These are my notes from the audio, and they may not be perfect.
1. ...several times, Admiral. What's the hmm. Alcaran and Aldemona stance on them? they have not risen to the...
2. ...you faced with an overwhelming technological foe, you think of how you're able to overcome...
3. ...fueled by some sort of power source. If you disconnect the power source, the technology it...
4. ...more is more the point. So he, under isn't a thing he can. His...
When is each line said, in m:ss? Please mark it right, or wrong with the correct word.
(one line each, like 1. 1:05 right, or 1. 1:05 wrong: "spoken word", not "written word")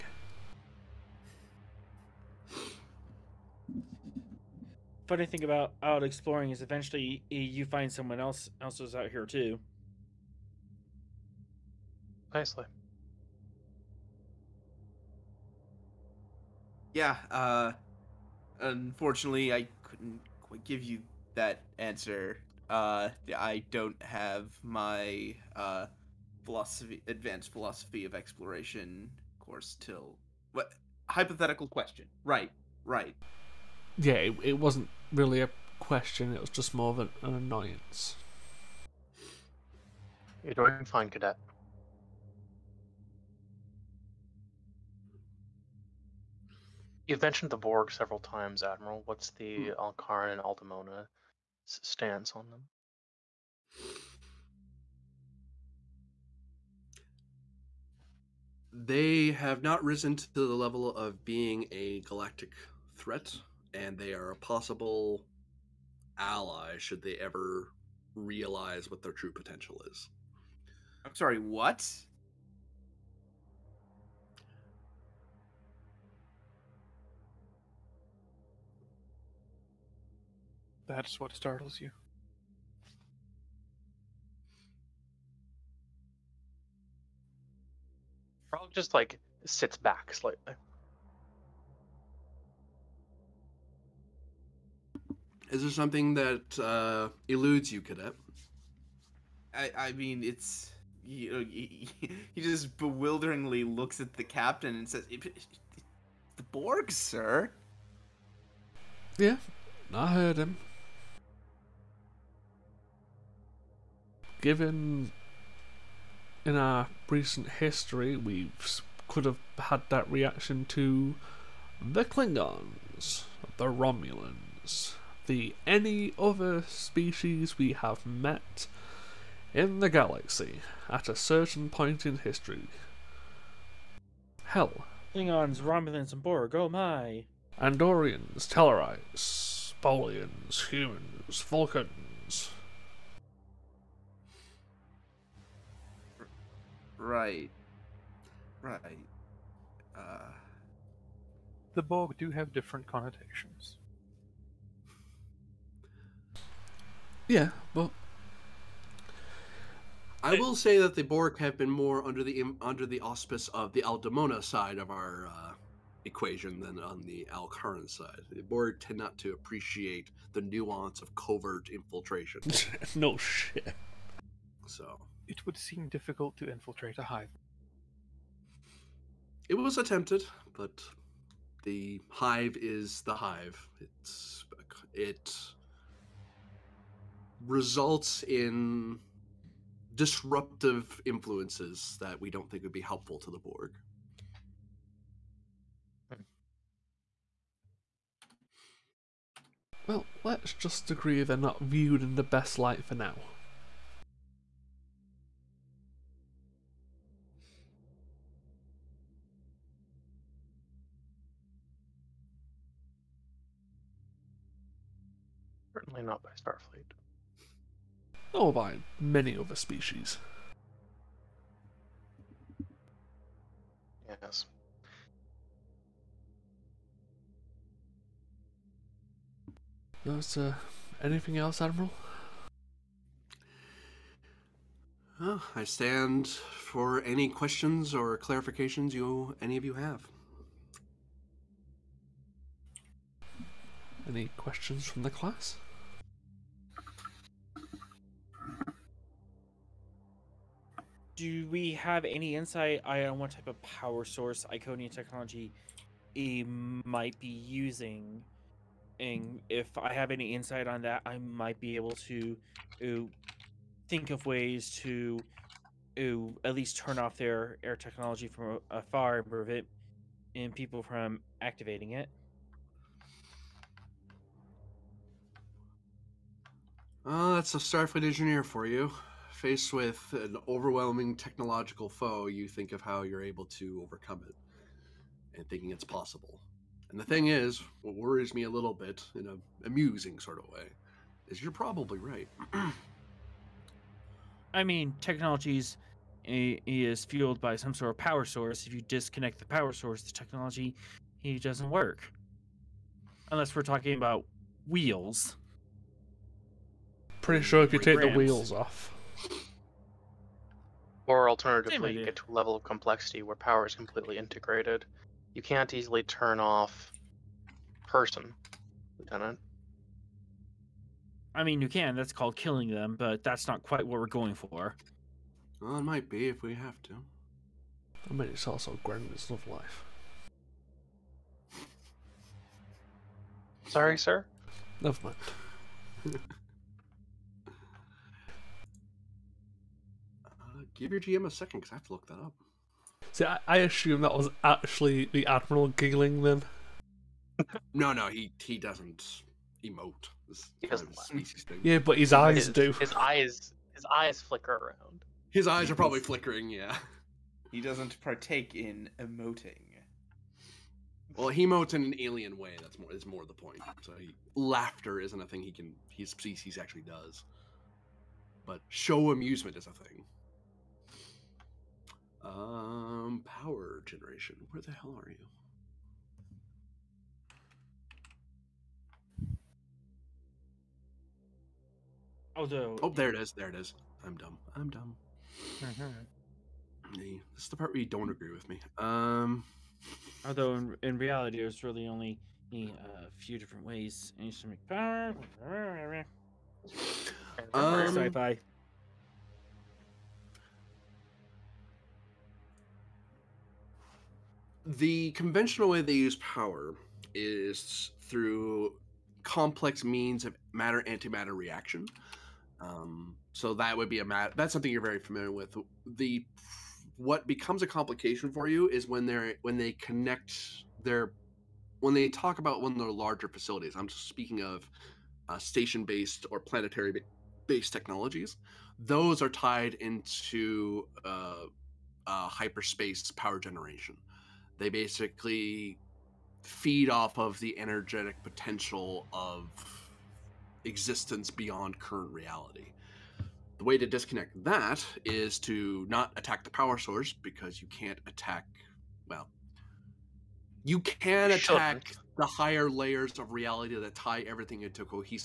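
1. 0:47 right
2. 4:38 right
3. 4:57 right
4. 6:02 wrong: "laughter", not "under".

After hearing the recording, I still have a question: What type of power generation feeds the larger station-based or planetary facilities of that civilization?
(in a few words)
hyperspace power generation.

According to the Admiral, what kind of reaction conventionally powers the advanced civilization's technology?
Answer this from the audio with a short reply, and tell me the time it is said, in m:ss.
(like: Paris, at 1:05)
matter antimatter reaction, at 6:50.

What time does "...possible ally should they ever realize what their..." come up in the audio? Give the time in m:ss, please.
1:04.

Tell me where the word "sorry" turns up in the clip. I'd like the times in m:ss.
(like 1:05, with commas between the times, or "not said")
1:11, 5:33.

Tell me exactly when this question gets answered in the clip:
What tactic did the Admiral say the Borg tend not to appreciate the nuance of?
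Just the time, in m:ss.
2:51.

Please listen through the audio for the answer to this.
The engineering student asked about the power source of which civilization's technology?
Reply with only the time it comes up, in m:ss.
4:14.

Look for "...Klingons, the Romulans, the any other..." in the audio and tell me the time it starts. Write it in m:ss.
2:02.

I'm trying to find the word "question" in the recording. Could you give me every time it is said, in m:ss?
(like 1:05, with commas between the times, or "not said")
0:31, 0:35, 3:57, 4:04.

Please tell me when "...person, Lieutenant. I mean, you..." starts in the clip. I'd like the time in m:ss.
5:17.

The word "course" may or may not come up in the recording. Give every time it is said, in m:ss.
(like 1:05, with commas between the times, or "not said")
0:29.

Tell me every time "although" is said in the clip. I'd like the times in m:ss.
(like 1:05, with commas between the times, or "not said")
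6:22, 6:30.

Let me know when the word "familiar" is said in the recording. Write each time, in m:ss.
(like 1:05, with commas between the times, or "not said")
6:55.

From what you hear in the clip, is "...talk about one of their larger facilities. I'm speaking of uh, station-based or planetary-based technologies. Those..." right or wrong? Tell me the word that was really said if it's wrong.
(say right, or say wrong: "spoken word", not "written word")
right.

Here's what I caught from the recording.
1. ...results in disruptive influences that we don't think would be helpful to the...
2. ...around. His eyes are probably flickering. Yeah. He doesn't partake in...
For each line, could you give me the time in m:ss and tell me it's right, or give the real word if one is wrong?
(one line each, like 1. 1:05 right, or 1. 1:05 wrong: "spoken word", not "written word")
1. 3:07 right
2. 5:54 right.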